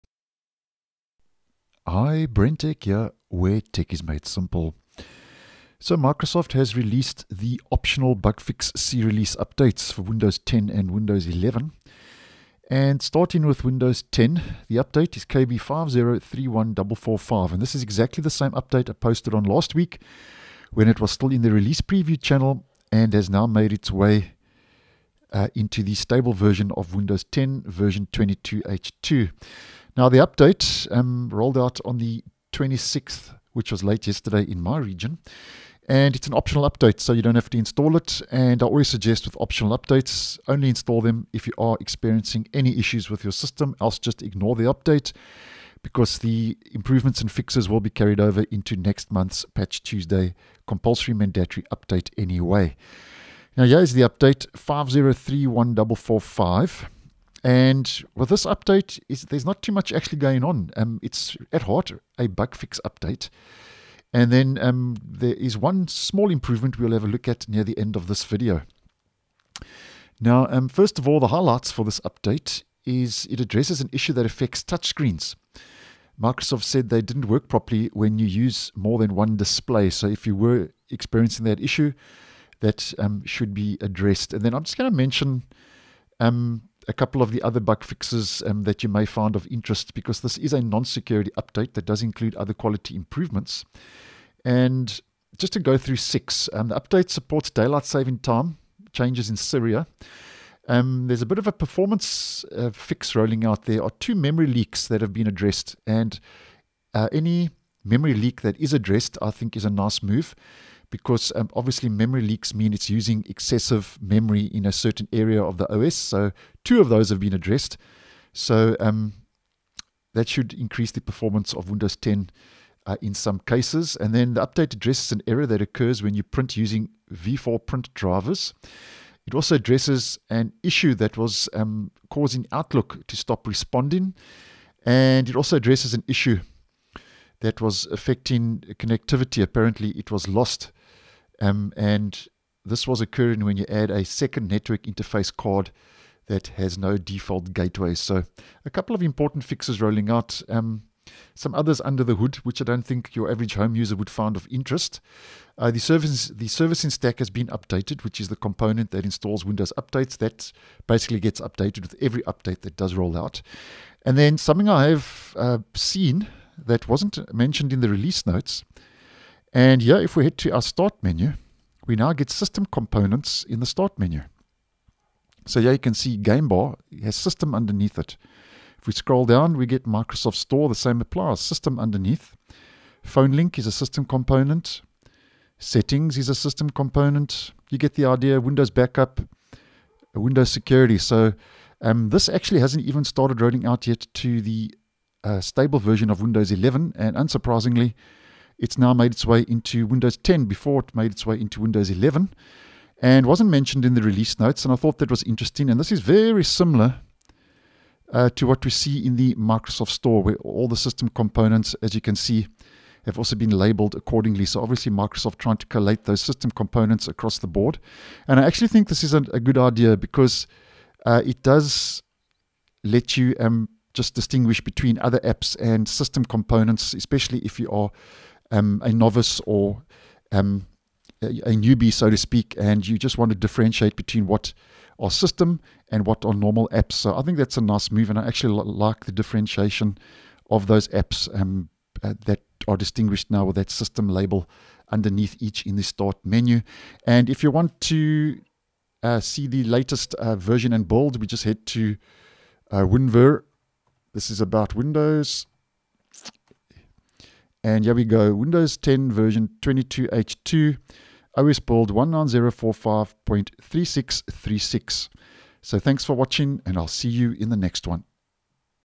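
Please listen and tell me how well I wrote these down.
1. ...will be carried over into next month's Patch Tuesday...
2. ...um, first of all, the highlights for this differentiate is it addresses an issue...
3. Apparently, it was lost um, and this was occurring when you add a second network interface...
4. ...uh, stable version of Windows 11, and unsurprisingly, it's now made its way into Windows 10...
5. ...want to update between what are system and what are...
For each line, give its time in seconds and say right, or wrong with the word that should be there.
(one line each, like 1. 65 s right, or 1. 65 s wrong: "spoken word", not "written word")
1. 47 s right
2. 70 s wrong: "update", not "differentiate"
3. 139 s right
4. 195 s right
5. 233 s wrong: "differentiate", not "update".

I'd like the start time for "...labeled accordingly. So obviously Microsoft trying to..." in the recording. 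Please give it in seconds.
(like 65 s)
213 s.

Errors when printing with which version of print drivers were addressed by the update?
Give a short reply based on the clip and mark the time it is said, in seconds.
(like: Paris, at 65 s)
v4, at 127 s.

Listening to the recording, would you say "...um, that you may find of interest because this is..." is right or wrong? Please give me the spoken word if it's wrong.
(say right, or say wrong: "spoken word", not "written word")
right.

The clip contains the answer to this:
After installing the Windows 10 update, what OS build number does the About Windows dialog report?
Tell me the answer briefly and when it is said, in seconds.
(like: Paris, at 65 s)
19045.3636, at 261 s.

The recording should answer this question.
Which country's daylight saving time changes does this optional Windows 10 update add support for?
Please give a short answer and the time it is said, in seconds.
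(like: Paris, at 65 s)
Syria, at 99 s.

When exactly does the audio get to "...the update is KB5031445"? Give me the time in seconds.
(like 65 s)
14 s.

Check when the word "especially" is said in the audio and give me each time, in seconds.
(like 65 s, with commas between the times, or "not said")
226 s.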